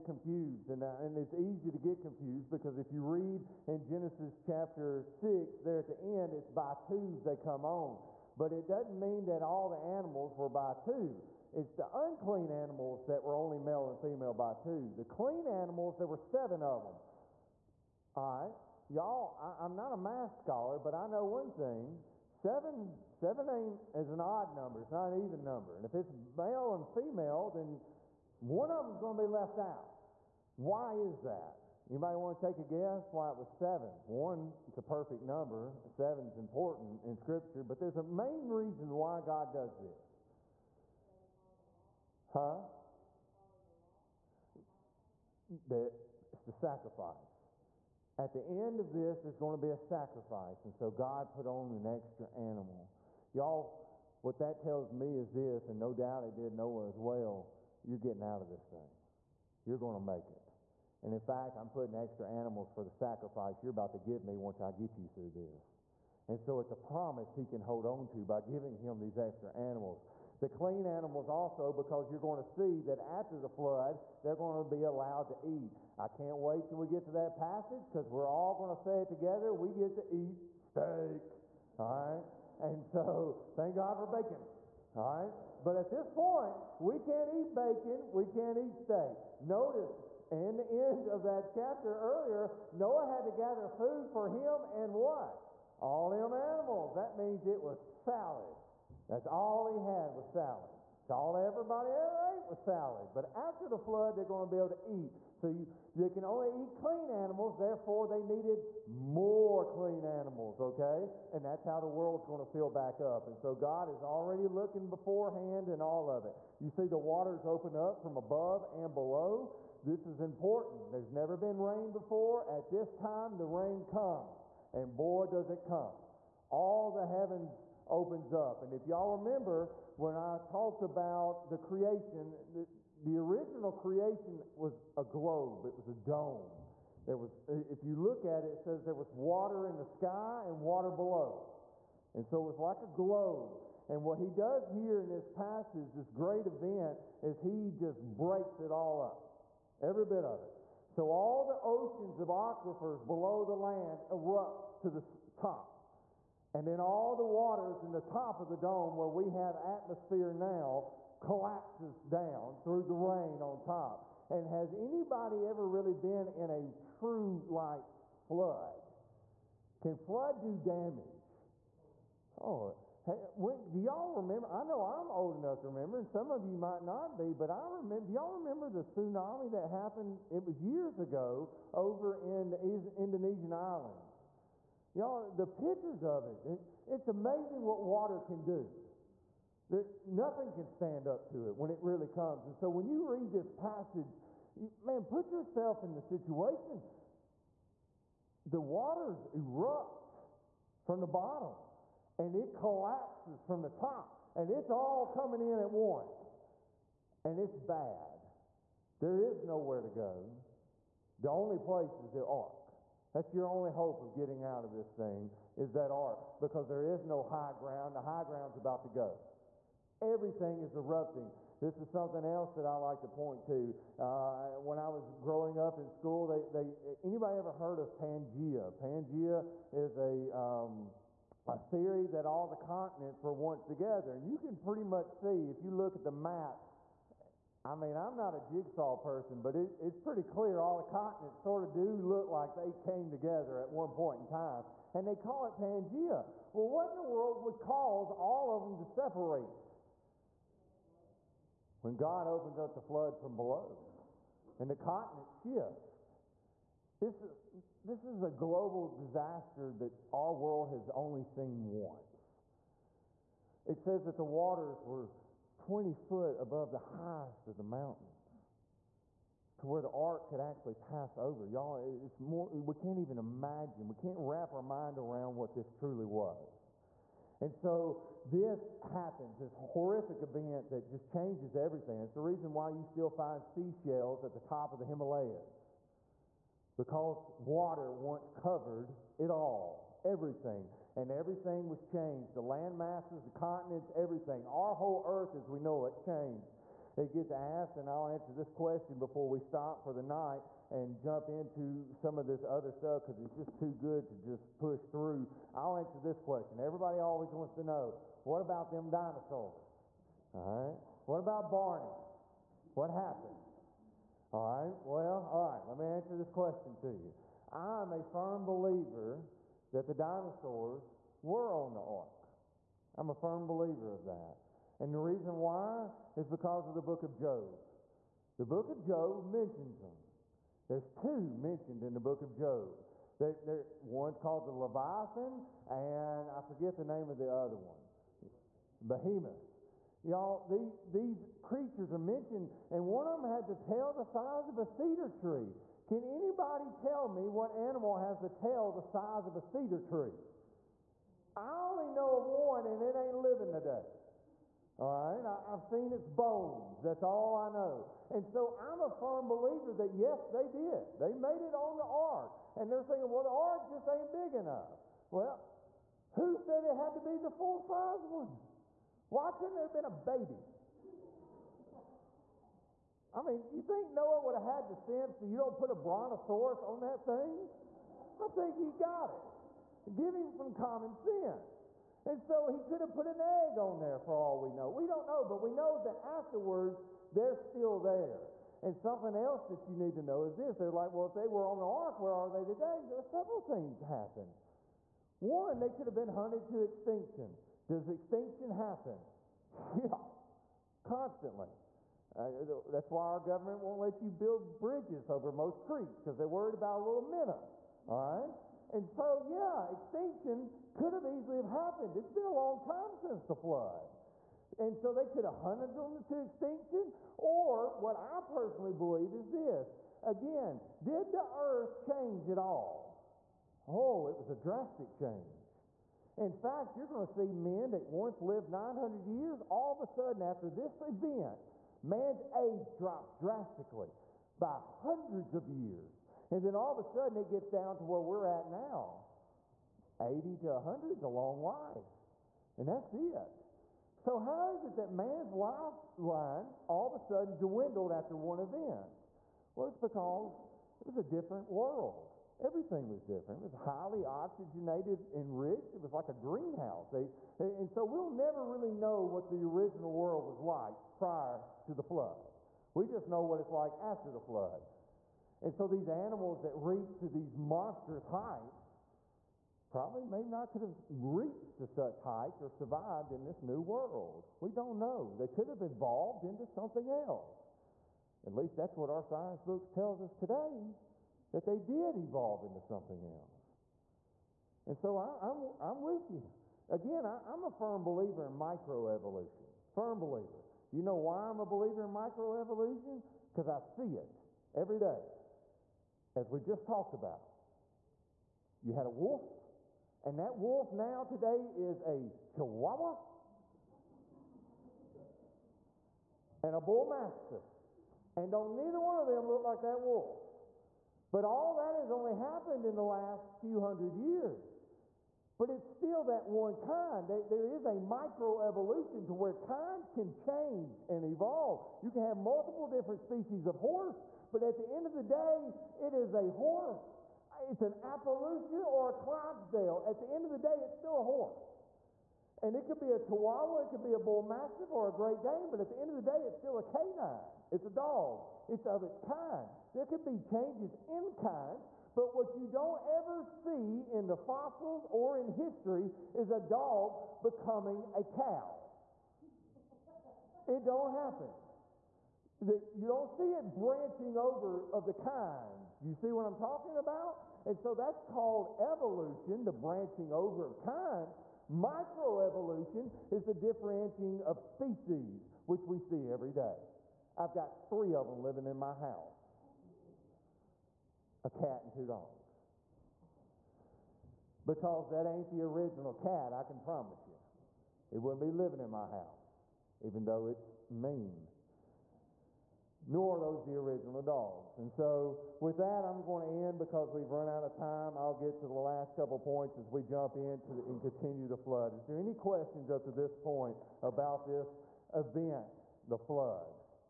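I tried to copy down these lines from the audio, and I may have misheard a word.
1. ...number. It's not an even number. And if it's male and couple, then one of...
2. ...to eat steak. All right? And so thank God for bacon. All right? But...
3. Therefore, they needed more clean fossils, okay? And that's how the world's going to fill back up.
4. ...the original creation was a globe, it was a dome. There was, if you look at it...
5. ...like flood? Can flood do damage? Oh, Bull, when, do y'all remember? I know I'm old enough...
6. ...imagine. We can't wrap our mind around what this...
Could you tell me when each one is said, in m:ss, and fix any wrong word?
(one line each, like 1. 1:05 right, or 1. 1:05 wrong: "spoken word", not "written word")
1. 0:24 wrong: "female", not "couple"
2. 1:19 right
3. 1:47 wrong: "animals", not "fossils"
4. 2:13 right
5. 2:47 wrong: "Hey", not "Bull"
6. 4:33 right.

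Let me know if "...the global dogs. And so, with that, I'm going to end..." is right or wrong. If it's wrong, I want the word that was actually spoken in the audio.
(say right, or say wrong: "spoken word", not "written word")
wrong: "original", not "global".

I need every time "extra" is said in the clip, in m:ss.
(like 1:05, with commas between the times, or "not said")
0:51, 1:01, 1:09.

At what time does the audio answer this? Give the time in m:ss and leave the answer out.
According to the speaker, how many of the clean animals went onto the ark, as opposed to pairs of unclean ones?
0:15.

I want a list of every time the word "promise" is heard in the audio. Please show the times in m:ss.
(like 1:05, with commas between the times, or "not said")
1:06, 9:36.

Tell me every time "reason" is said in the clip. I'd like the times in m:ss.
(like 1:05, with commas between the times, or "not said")
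0:38, 4:42, 5:24.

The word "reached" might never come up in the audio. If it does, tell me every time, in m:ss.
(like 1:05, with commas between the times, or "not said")
7:46, 7:51.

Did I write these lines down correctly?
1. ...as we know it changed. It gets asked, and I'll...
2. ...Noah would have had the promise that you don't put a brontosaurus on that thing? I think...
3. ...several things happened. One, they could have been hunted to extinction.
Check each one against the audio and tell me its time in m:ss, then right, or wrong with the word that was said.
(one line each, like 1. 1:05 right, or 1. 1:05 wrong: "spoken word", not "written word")
1. 4:55 right
2. 6:13 wrong: "sense", not "promise"
3. 6:33 right.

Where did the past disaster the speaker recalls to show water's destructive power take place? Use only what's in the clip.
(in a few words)
Indonesian islands.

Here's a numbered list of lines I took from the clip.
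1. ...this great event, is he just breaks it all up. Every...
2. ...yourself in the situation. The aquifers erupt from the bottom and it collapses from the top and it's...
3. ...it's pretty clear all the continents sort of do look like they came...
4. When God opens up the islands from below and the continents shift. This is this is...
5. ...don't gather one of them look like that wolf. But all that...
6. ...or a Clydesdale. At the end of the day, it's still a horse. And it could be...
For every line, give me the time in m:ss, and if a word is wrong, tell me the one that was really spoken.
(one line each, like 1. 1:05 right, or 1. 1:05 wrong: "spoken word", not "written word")
1. 2:25 right
2. 3:15 wrong: "waters", not "aquifers"
3. 3:59 right
4. 4:11 wrong: "floods", not "islands"
5. 8:28 wrong: "neither", not "gather"
6. 8:48 right.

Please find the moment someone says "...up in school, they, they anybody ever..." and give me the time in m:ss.
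3:45.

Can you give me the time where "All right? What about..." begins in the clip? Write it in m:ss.
5:10.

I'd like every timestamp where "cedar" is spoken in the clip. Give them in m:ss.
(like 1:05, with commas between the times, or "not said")
5:44, 5:49.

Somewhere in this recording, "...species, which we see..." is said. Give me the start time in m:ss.
9:24.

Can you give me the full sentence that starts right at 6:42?
Uh, that's why our government won't let you build bridges over most creeks because they're worried about a little minnow.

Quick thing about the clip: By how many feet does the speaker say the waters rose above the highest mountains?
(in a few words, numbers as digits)
20.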